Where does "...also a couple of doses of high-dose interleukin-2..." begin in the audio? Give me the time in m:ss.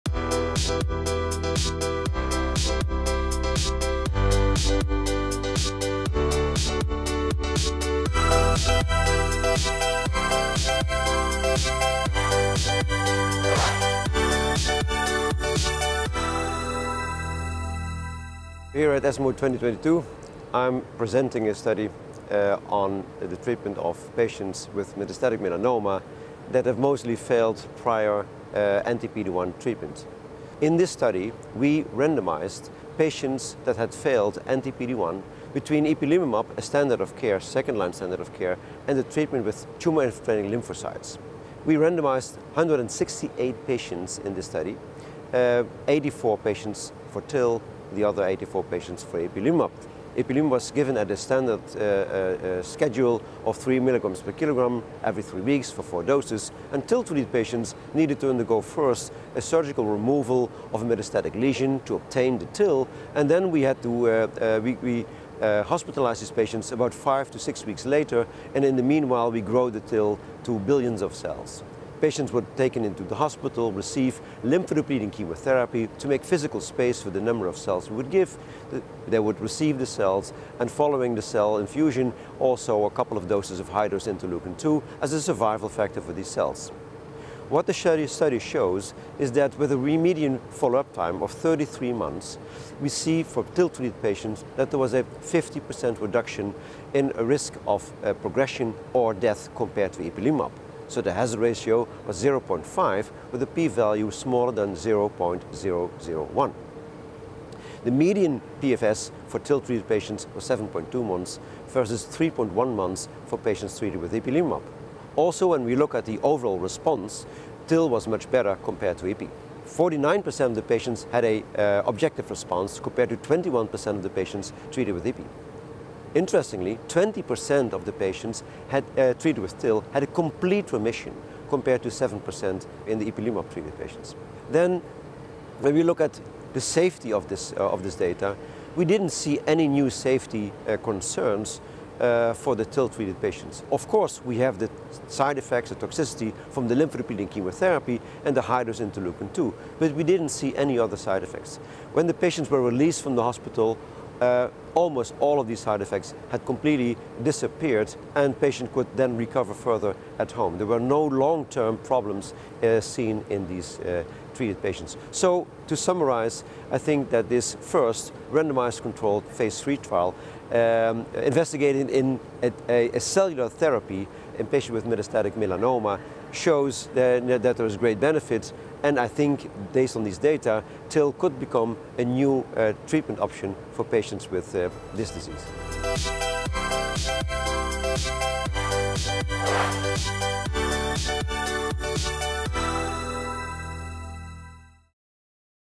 1:22.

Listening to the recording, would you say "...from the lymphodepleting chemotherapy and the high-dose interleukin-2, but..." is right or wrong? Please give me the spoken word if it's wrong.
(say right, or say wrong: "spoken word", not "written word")
right.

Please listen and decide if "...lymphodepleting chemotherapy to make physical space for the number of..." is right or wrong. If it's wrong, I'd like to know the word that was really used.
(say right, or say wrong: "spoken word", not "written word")
right.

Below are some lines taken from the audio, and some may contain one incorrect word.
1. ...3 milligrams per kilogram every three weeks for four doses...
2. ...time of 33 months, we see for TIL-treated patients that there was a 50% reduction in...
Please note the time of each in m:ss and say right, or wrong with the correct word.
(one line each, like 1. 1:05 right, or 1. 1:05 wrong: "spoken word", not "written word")
1. 0:53 right
2. 1:30 right.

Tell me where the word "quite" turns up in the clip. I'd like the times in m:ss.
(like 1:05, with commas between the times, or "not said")
not said.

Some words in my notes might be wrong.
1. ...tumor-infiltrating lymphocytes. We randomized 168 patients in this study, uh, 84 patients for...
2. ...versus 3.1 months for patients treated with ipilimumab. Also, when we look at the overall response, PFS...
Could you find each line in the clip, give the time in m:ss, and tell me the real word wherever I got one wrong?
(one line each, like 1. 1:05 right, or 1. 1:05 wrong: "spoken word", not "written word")
1. 0:39 right
2. 1:51 wrong: "TIL", not "PFS".